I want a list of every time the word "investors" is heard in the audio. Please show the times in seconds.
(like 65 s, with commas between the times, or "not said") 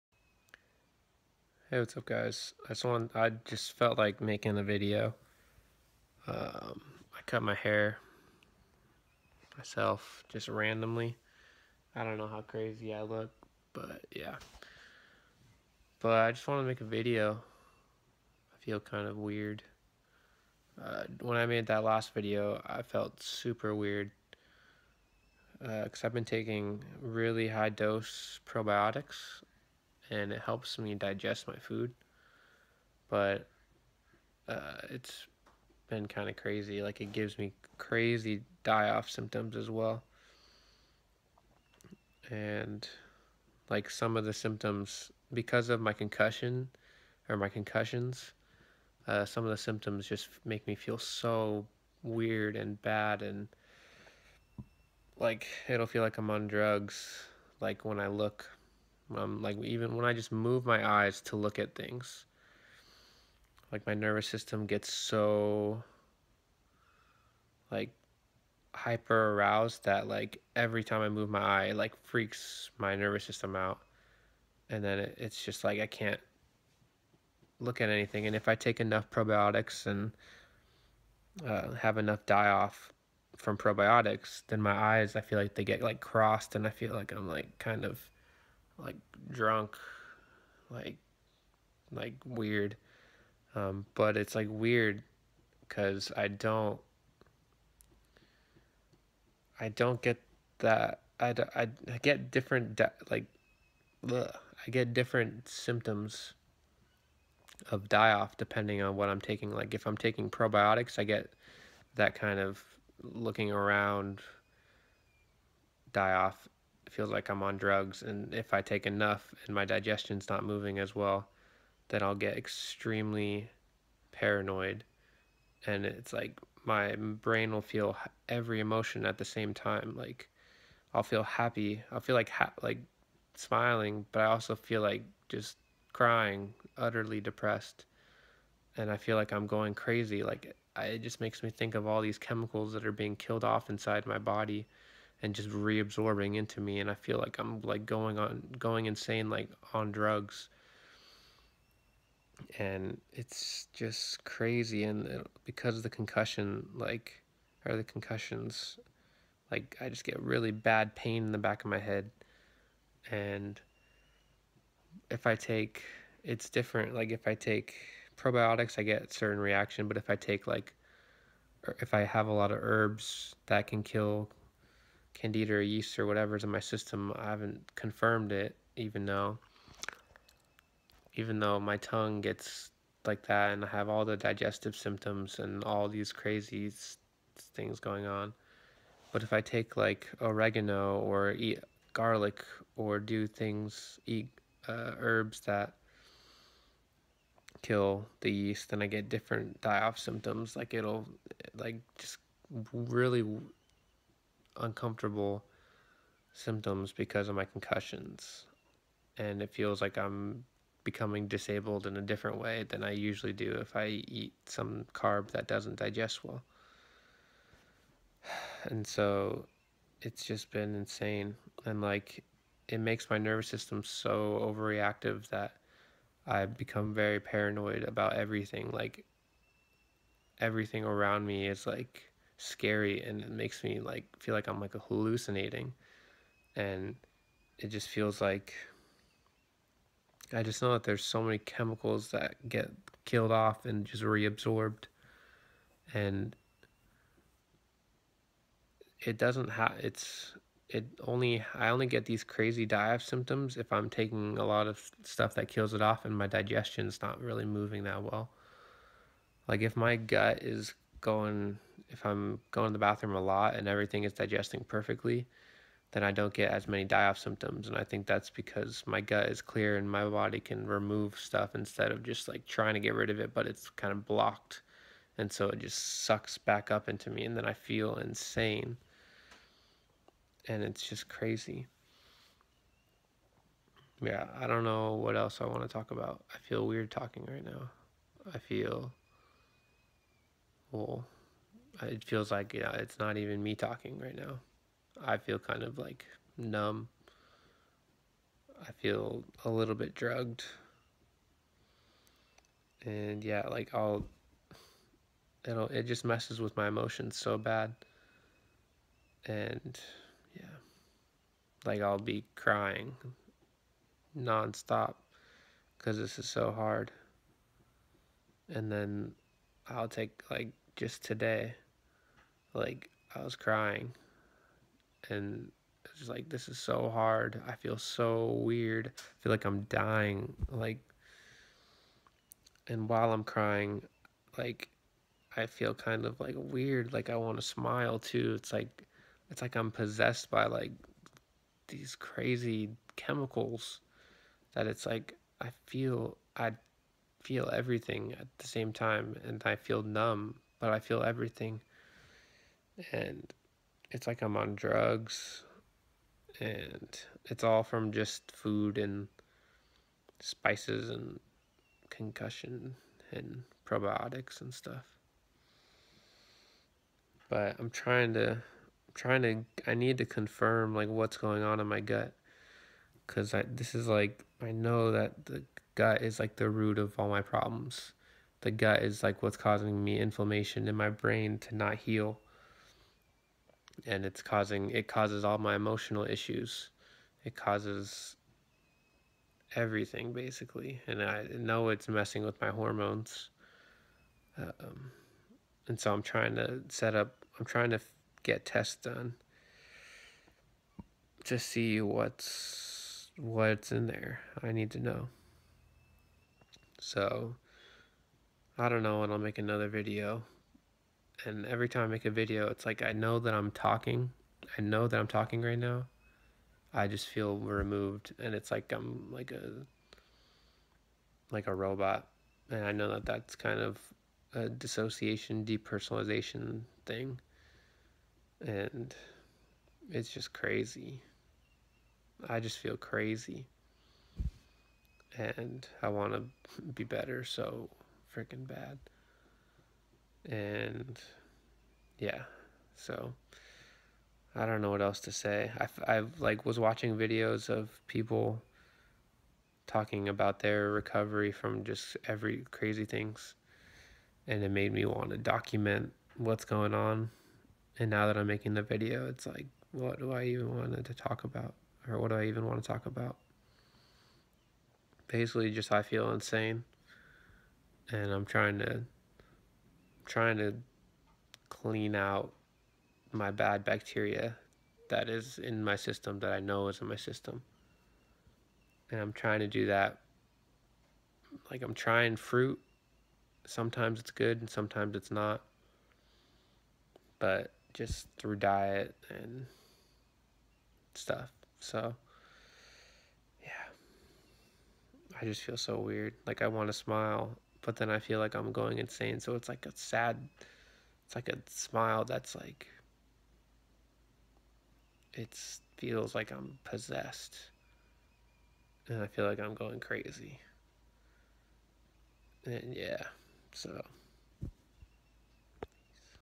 not said.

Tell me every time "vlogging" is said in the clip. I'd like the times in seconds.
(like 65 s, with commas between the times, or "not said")
not said.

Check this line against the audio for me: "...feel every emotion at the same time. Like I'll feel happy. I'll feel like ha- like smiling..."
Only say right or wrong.
right.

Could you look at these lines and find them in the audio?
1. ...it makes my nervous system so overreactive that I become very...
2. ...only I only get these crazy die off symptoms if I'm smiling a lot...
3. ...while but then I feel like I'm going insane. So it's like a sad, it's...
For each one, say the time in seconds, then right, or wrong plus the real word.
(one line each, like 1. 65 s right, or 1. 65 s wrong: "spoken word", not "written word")
1. 222 s right
2. 251 s wrong: "taking", not "smiling"
3. 496 s wrong: "smile", not "while".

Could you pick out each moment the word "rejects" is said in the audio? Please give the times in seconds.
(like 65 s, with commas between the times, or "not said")
not said.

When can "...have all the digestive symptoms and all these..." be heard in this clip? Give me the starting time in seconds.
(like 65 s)
183 s.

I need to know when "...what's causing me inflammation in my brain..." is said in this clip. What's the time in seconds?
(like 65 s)
379 s.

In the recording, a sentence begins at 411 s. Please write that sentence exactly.
And every time I make a video, it's like I know that I'm talking.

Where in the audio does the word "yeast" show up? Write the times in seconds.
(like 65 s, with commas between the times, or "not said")
175 s, 198 s.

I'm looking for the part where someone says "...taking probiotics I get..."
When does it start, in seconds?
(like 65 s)
109 s.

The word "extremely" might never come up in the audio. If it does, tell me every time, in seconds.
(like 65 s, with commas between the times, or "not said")
122 s.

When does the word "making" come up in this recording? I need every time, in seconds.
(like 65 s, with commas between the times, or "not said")
4 s, 458 s.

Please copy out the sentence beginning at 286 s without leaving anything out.
I feel weird talking right now.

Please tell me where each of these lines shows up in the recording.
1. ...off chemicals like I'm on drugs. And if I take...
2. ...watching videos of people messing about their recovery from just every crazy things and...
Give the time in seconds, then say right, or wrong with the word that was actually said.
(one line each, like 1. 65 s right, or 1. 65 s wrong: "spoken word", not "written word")
1. 116 s wrong: "feels", not "chemicals"
2. 446 s wrong: "talking", not "messing".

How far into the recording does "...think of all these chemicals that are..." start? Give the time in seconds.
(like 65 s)
141 s.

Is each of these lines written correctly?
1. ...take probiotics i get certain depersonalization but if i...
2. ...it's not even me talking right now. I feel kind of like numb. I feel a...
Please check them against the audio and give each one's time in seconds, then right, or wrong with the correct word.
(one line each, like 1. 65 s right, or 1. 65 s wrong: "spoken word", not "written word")
1. 167 s wrong: "reaction", not "depersonalization"
2. 292 s right.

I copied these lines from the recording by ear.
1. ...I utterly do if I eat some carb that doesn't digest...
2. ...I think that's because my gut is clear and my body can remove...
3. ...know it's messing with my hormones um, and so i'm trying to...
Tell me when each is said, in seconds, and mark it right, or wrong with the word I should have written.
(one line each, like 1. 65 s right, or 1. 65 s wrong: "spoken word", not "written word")
1. 212 s wrong: "usually", not "utterly"
2. 267 s right
3. 391 s right.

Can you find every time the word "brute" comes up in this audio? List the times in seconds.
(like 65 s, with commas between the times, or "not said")
not said.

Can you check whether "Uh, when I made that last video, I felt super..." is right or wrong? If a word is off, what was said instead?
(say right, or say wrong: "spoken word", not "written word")
right.